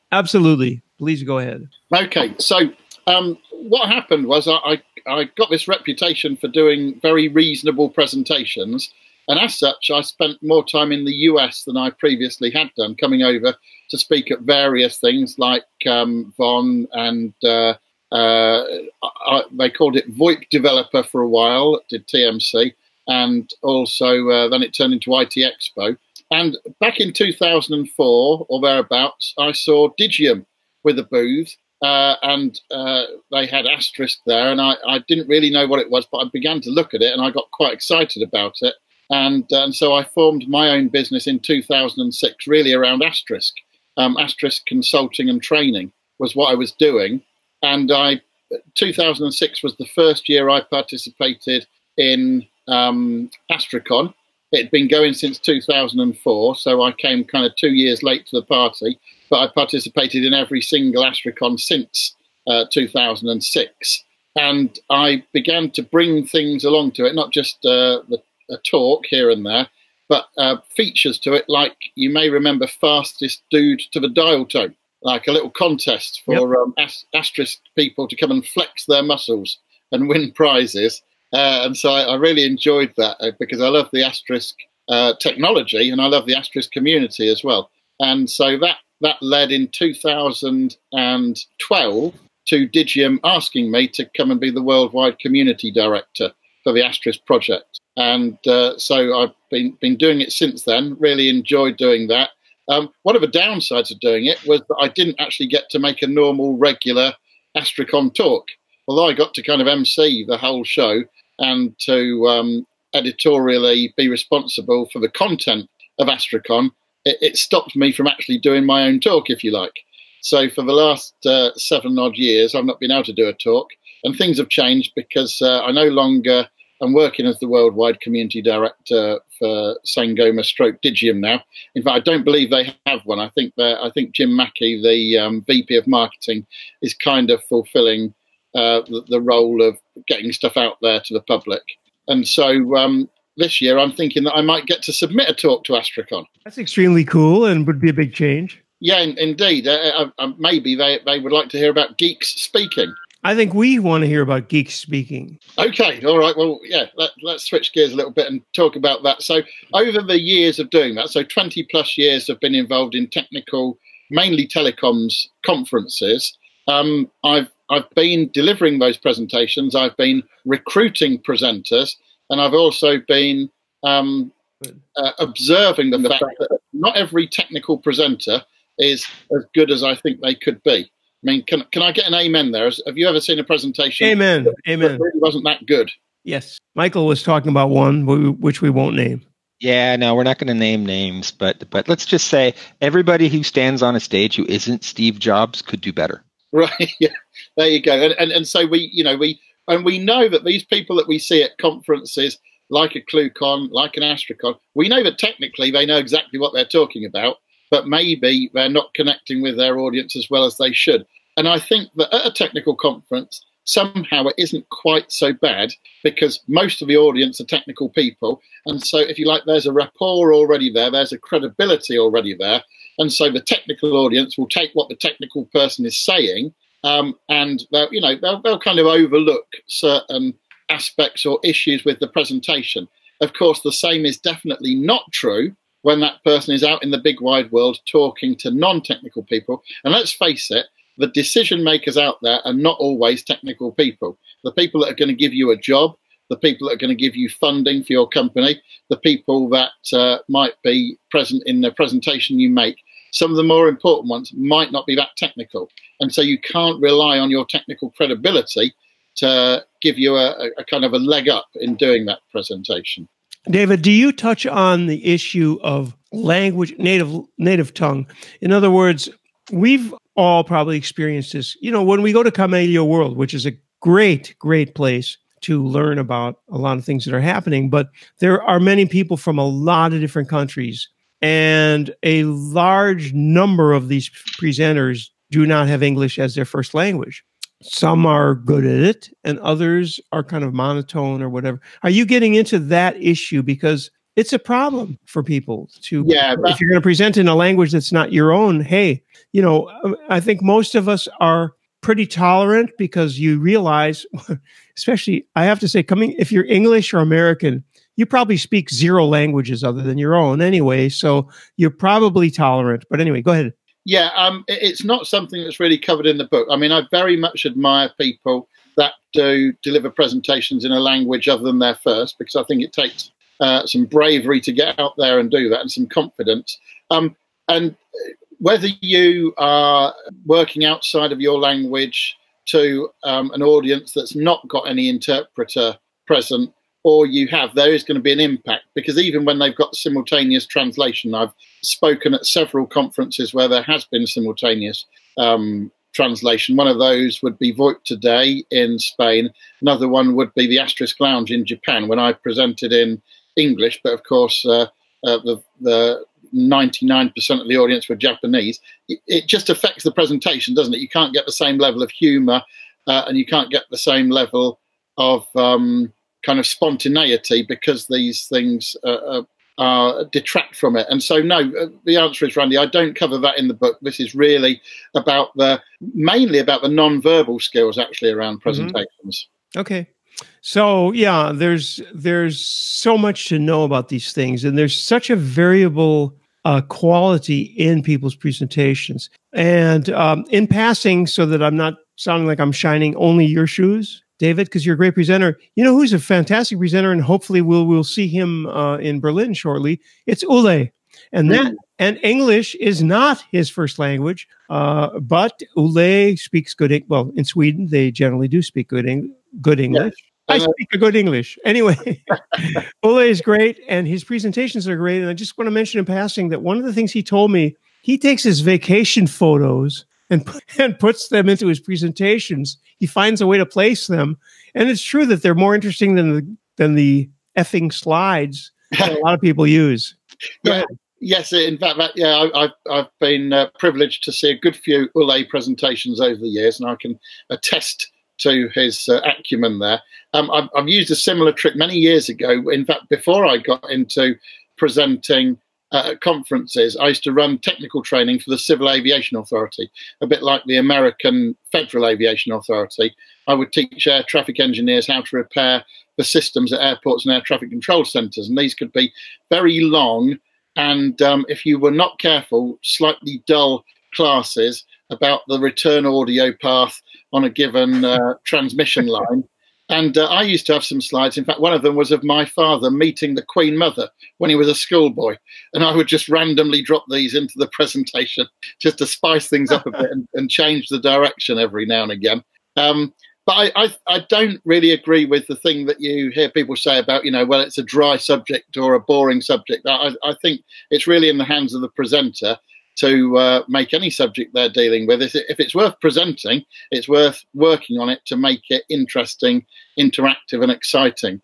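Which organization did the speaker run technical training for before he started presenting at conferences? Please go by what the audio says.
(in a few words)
Civil Aviation Authority.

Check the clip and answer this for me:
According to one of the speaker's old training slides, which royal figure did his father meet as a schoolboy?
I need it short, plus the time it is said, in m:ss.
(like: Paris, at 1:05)
the Queen Mother, at 7:53.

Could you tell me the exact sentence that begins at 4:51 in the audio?
Are you getting into that issue?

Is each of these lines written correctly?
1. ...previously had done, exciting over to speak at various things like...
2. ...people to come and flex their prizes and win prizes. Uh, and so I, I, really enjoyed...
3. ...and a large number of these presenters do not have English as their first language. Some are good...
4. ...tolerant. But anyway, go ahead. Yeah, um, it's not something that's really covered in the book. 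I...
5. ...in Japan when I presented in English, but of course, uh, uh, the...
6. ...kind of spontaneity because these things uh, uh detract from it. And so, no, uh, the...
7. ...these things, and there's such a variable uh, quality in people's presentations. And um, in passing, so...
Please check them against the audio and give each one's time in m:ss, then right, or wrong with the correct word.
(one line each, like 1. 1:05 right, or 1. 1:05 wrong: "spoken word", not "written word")
1. 0:11 wrong: "coming", not "exciting"
2. 1:17 wrong: "muscles", not "prizes"
3. 4:41 right
4. 5:12 right
5. 5:51 right
6. 6:06 right
7. 6:23 right.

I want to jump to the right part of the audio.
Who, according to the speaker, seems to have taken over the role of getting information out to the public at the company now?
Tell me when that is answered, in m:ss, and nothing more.
2:14.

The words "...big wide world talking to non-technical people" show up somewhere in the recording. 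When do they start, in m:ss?
3:56.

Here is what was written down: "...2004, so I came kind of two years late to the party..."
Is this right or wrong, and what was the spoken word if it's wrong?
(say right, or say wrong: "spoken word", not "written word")
right.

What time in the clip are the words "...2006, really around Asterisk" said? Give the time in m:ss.
0:41.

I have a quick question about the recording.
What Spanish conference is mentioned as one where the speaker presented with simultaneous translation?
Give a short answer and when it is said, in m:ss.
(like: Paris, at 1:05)
VoIP2Day, at 5:47.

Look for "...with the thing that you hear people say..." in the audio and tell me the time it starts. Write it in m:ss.
8:05.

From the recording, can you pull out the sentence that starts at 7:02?
He finds a way to place them.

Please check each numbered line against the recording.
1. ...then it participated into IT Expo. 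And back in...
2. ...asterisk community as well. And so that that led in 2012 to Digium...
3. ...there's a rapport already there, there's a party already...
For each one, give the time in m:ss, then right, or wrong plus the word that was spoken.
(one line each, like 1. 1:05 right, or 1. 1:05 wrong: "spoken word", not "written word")
1. 0:24 wrong: "turned", not "participated"
2. 1:26 right
3. 3:39 wrong: "credibility", not "party".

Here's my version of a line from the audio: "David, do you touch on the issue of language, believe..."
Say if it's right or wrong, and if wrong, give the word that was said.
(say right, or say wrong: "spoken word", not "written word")
wrong: "native", not "believe".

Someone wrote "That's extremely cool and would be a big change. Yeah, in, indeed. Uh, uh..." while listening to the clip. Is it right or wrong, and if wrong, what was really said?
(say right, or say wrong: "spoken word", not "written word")
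right.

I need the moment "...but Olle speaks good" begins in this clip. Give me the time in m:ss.
6:44.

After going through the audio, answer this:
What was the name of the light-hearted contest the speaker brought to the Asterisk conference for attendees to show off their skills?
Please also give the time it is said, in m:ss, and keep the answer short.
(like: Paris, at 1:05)
Fastest Dude to the Dial Tone, at 1:12.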